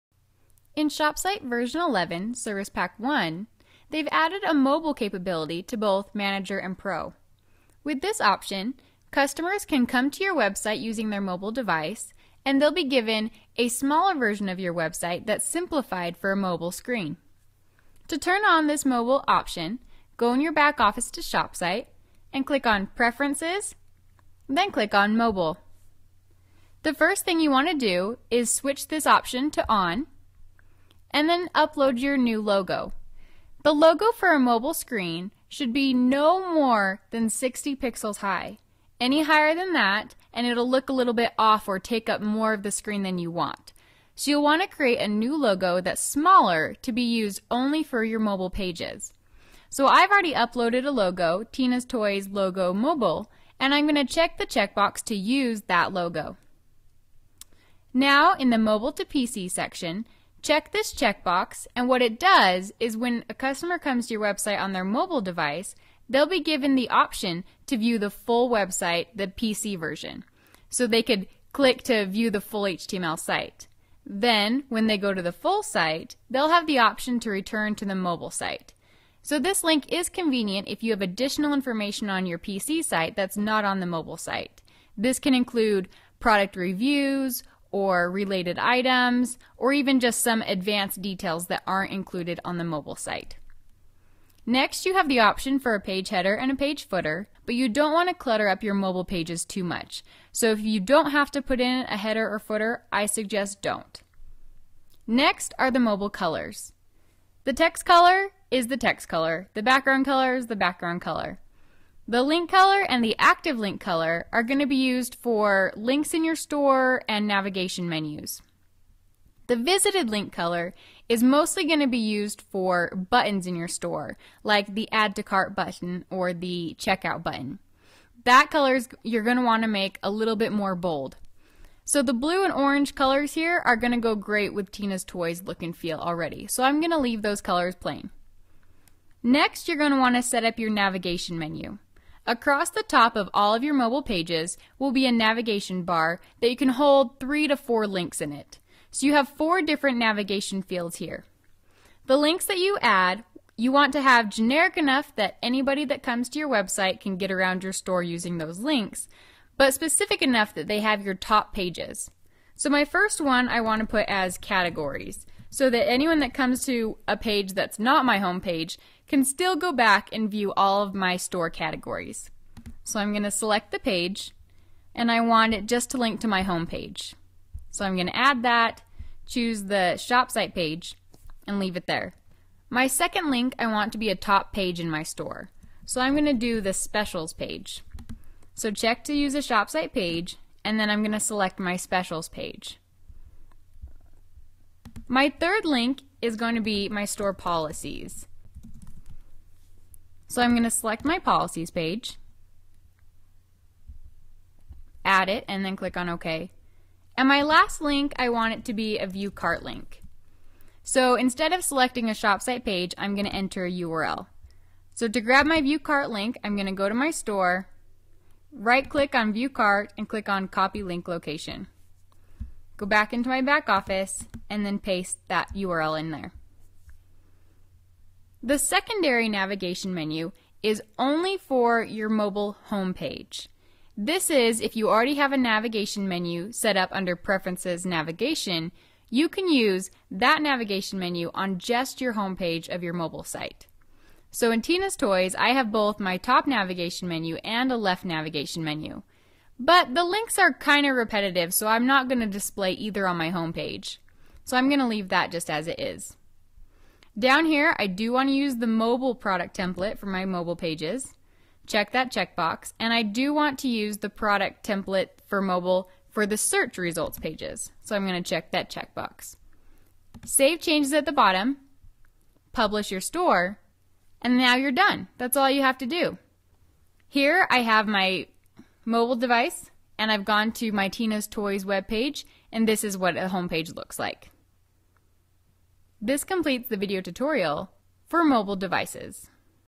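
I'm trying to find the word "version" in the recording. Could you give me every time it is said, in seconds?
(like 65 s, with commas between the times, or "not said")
1 s, 14 s, 69 s.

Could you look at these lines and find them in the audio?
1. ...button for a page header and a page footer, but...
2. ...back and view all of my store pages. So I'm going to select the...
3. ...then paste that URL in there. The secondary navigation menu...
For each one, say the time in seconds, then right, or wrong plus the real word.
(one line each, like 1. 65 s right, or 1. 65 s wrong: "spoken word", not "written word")
1. 95 s wrong: "option", not "button"
2. 169 s wrong: "categories", not "pages"
3. 224 s right.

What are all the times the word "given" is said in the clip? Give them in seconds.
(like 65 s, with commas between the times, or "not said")
12 s, 66 s.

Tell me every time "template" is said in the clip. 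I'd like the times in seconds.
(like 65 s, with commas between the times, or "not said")
259 s, 264 s.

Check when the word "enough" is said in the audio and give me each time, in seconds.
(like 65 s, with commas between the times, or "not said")
154 s, 160 s.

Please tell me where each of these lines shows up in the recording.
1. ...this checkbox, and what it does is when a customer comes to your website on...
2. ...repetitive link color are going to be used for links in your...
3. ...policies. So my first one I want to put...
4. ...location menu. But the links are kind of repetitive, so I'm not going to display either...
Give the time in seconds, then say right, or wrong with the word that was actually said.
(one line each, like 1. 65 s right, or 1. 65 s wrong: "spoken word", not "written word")
1. 60 s right
2. 113 s wrong: "active", not "repetitive"
3. 161 s wrong: "pages", not "policies"
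4. 248 s wrong: "navigation", not "location".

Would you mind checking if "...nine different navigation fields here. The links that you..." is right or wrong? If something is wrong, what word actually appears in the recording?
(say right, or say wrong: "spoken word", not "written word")
wrong: "four", not "nine".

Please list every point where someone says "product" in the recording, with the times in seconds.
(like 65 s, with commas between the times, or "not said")
86 s, 259 s, 264 s.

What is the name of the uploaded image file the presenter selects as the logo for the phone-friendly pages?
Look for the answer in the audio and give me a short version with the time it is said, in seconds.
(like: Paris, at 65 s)
Tina's Toys Logo Mobile, at 51 s.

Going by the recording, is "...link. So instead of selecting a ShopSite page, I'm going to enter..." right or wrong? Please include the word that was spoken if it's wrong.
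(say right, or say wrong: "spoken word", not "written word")
right.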